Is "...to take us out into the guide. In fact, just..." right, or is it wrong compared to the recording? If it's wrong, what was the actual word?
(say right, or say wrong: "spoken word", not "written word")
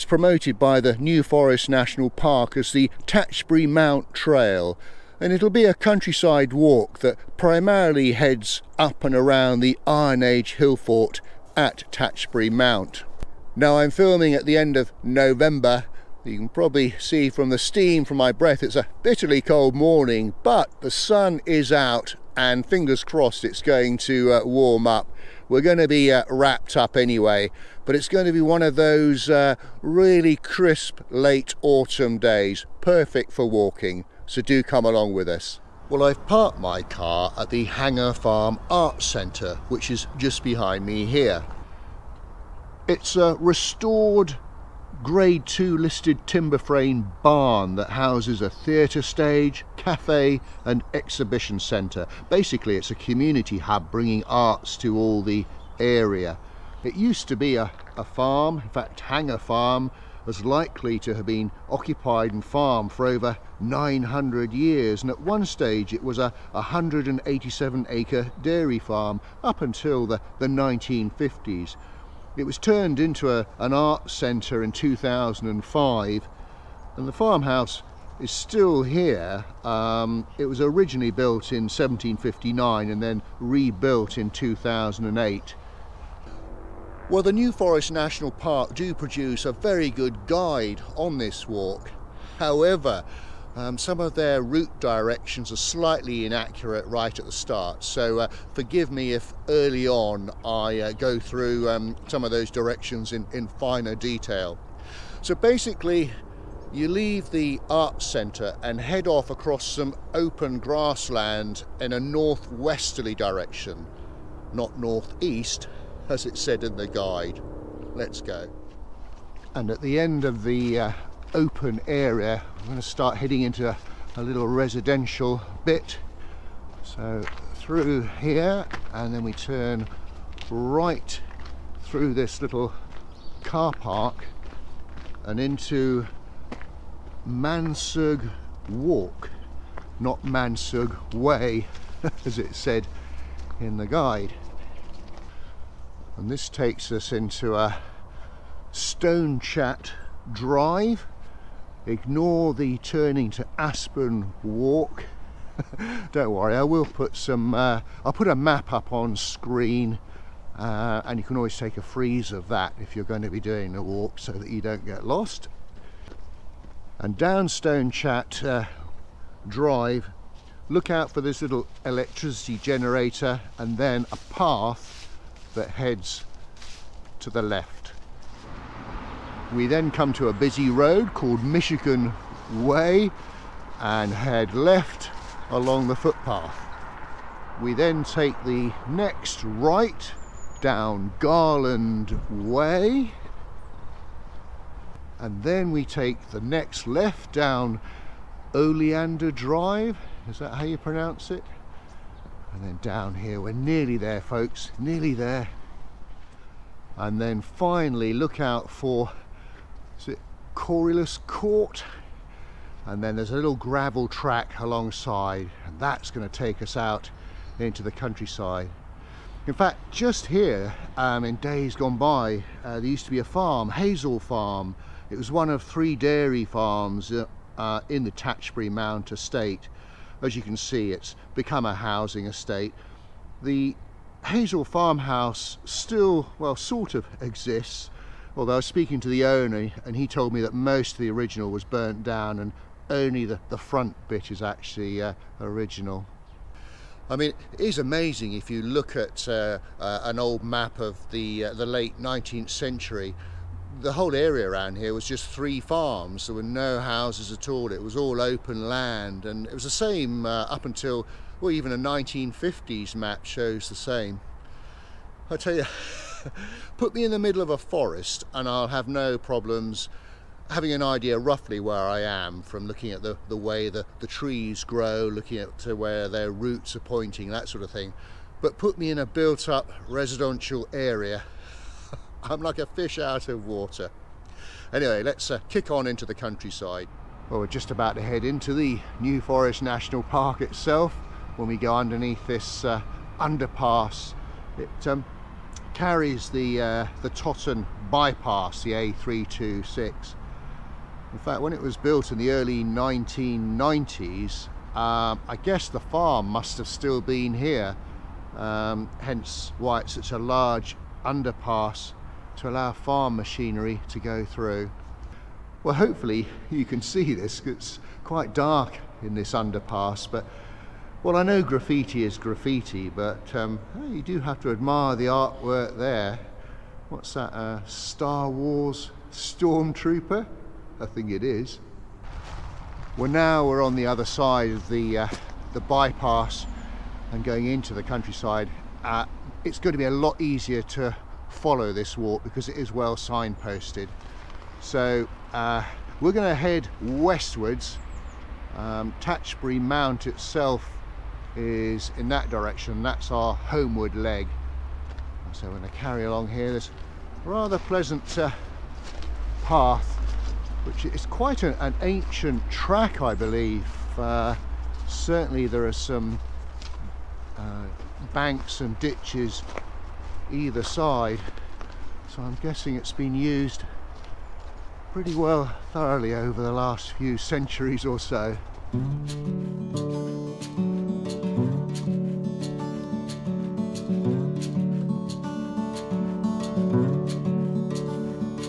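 wrong: "countryside", not "guide".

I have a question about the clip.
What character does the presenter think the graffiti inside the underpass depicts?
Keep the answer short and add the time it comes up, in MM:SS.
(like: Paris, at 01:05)
Star Wars Stormtrooper, at 05:27.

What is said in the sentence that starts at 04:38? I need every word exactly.
But put me in a built up residential area.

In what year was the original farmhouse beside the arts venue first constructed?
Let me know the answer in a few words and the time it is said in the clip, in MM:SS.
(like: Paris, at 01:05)
1759, at 01:21.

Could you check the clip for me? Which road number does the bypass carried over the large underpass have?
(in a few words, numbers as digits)
A326.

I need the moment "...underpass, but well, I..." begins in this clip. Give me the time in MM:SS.
05:19.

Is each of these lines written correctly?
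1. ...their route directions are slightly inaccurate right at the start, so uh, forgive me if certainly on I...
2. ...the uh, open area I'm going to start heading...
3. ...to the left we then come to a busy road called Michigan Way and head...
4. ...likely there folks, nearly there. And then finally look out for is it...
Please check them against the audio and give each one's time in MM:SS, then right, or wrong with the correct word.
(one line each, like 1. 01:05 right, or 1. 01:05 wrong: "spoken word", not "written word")
1. 01:34 wrong: "early", not "certainly"
2. 02:00 right
3. 02:57 right
4. 03:23 wrong: "nearly", not "likely".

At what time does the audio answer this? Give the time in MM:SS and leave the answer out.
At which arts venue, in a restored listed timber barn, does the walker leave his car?
00:37.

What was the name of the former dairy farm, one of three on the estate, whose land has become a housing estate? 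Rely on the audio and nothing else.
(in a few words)
Hazel Farm.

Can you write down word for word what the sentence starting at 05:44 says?
So uh, we're going to head westwards.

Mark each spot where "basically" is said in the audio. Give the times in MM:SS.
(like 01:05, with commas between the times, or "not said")
00:52, 01:45.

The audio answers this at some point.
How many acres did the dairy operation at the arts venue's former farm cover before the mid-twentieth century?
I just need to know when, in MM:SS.
01:06.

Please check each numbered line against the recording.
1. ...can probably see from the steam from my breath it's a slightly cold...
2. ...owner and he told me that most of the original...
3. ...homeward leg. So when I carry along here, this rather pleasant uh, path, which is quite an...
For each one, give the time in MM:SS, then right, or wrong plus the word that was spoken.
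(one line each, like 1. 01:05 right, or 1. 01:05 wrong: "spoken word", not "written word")
1. 00:16 wrong: "bitterly", not "slightly"
2. 03:59 right
3. 05:53 right.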